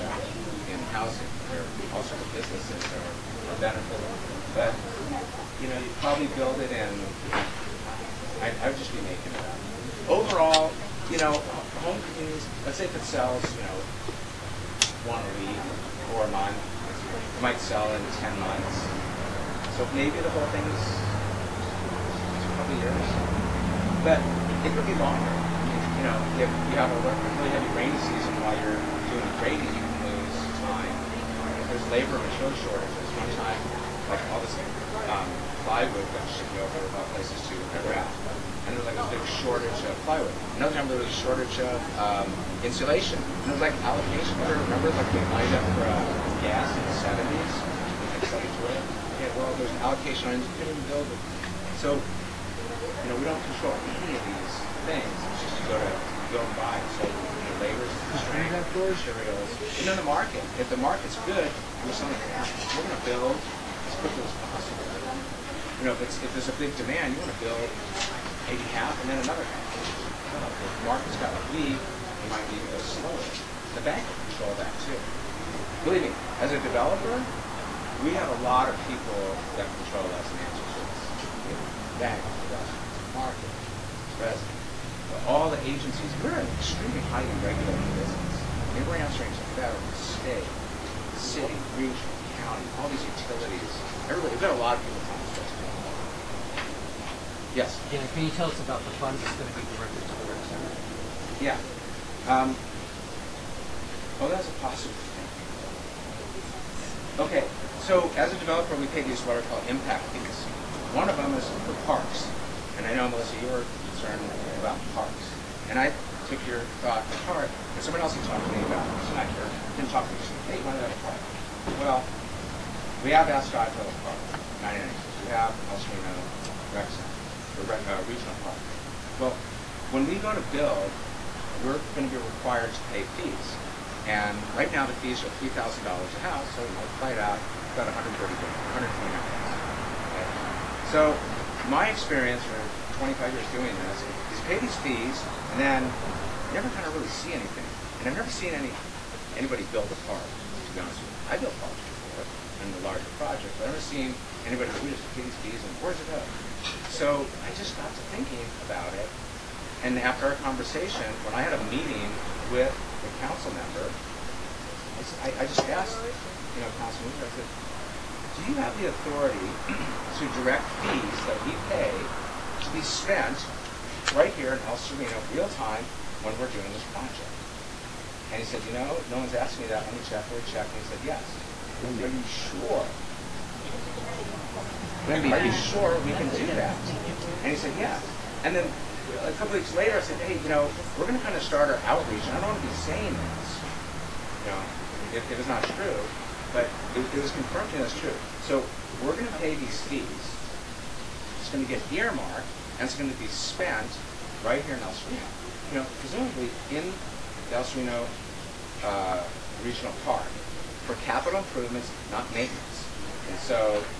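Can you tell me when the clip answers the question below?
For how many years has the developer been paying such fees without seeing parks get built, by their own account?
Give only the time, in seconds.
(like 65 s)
142 s.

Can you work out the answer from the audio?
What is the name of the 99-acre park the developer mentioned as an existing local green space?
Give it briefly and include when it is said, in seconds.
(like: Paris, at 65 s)
Ascot Hill Park, at 123 s.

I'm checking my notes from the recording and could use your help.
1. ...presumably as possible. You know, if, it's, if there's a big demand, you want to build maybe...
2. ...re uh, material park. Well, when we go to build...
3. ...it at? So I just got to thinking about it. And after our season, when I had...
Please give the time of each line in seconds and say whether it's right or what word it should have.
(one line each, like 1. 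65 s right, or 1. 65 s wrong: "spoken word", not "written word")
1. 63 s wrong: "quickly", not "presumably"
2. 127 s wrong: "regional", not "material"
3. 155 s wrong: "conversation", not "season".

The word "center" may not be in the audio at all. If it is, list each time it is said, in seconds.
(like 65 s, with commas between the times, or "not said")
100 s, 126 s.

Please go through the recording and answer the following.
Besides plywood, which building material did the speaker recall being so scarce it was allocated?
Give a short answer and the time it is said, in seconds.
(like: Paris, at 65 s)
Insulation, at 42 s.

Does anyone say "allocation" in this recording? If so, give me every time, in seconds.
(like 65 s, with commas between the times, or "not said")
43 s, 49 s.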